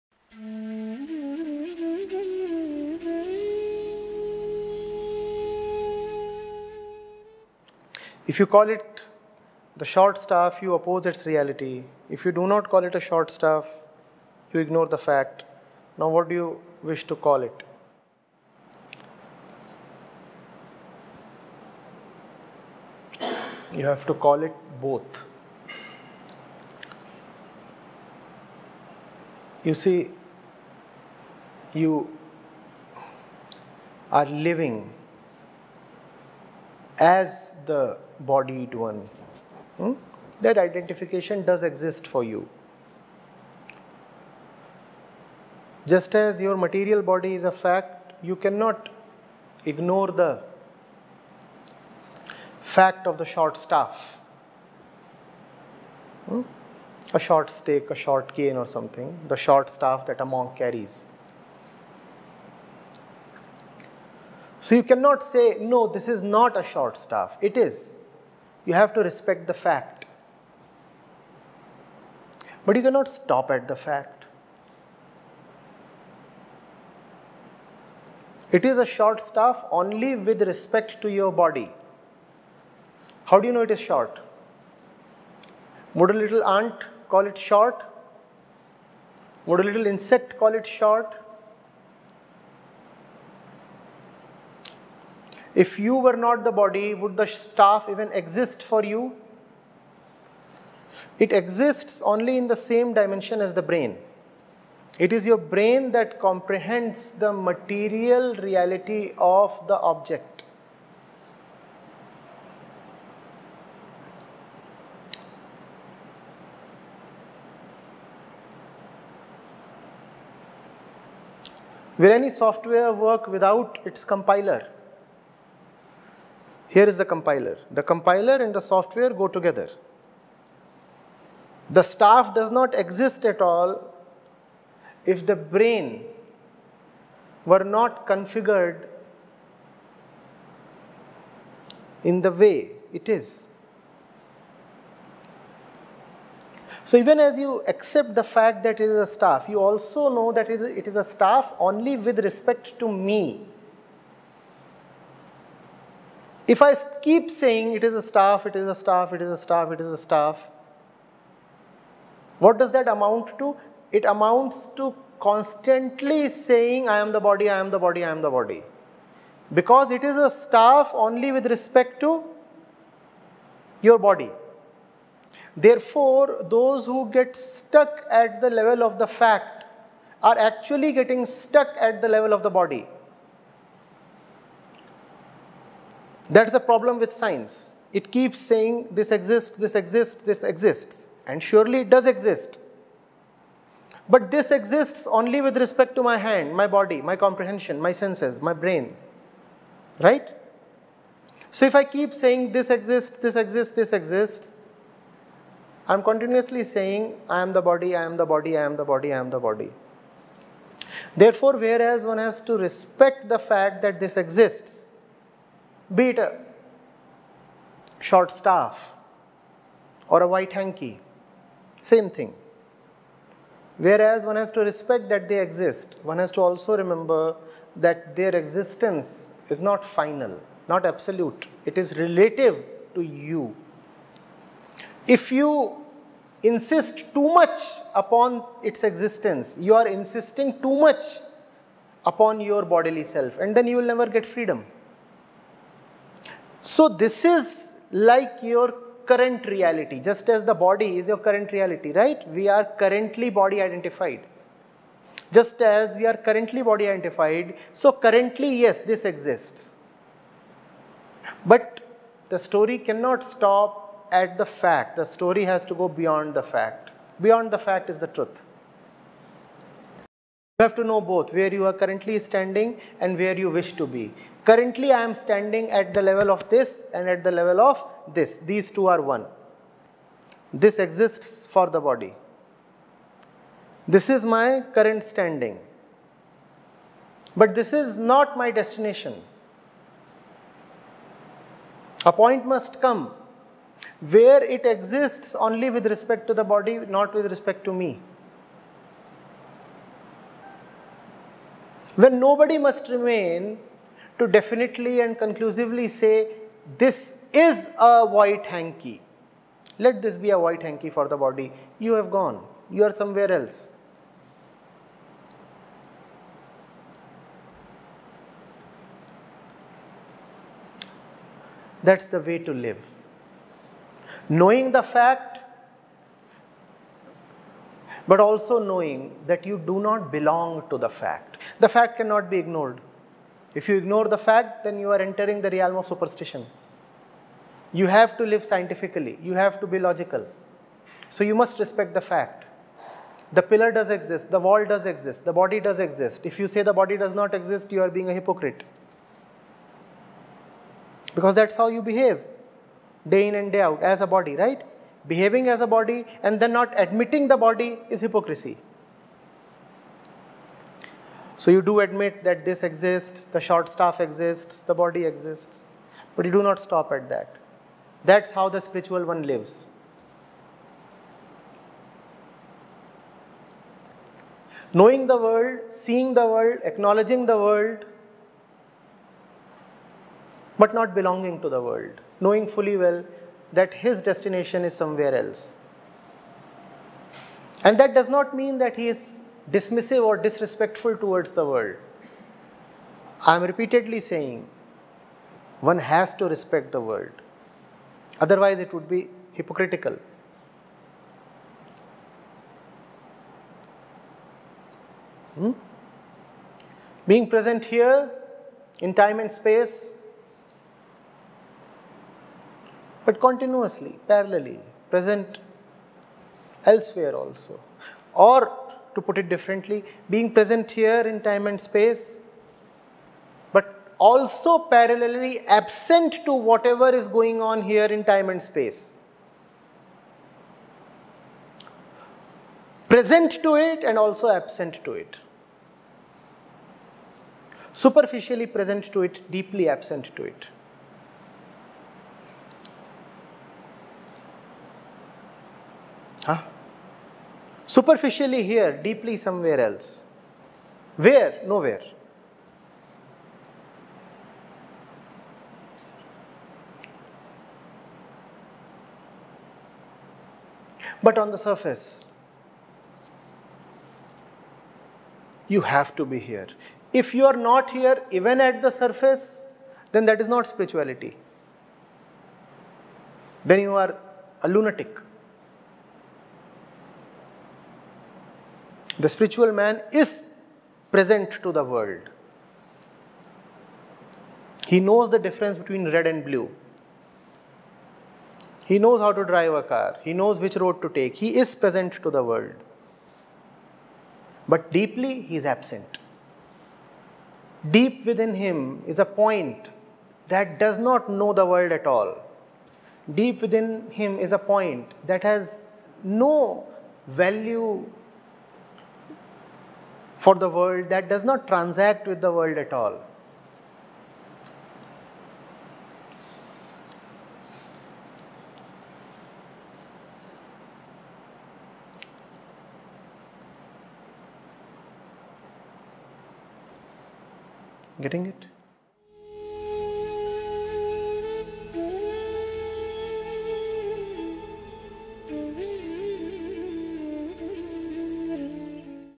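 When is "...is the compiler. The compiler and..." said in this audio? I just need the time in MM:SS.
02:06.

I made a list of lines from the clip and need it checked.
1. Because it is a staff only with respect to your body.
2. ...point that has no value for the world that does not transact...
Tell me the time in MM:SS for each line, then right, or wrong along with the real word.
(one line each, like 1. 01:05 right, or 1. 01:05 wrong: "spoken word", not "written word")
1. 02:49 right
2. 08:24 right.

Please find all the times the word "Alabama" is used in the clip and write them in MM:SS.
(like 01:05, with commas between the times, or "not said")
not said.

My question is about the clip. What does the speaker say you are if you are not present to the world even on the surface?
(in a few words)
A lunatic.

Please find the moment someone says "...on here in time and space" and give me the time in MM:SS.
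07:07.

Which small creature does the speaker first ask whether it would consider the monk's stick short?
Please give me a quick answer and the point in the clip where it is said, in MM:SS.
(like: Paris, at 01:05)
A little ant, at 01:26.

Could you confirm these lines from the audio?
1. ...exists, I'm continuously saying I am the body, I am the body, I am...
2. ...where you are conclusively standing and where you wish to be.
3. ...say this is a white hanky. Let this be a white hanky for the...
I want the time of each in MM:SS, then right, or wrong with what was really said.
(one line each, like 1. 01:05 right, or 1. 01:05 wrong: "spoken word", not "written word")
1. 03:23 right
2. 04:31 wrong: "currently", not "conclusively"
3. 05:05 right.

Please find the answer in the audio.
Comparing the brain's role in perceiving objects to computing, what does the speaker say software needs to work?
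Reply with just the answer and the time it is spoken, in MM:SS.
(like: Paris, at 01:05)
its compiler, at 02:03.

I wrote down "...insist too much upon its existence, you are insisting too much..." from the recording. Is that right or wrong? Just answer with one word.
right.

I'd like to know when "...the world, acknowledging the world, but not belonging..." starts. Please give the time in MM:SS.
06:16.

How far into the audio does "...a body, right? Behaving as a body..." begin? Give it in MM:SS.
05:54.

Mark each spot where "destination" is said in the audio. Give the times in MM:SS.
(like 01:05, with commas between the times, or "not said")
04:48, 06:24.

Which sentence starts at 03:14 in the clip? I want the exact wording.
But this exists only with respect to my hand, my body, my comprehension, my senses, my brain.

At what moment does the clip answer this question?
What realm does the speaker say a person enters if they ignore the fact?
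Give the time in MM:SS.
05:35.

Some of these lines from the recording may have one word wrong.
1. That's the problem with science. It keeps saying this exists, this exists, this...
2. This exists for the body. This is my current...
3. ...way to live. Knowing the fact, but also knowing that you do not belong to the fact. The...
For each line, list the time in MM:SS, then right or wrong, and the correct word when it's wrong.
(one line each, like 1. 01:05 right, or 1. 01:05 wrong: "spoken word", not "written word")
1. 03:06 right
2. 04:40 right
3. 05:22 right.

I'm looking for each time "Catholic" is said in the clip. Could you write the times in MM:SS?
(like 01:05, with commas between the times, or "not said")
not said.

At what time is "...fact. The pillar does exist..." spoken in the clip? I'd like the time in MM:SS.
05:42.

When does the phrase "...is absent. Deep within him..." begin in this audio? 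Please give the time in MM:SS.
08:15.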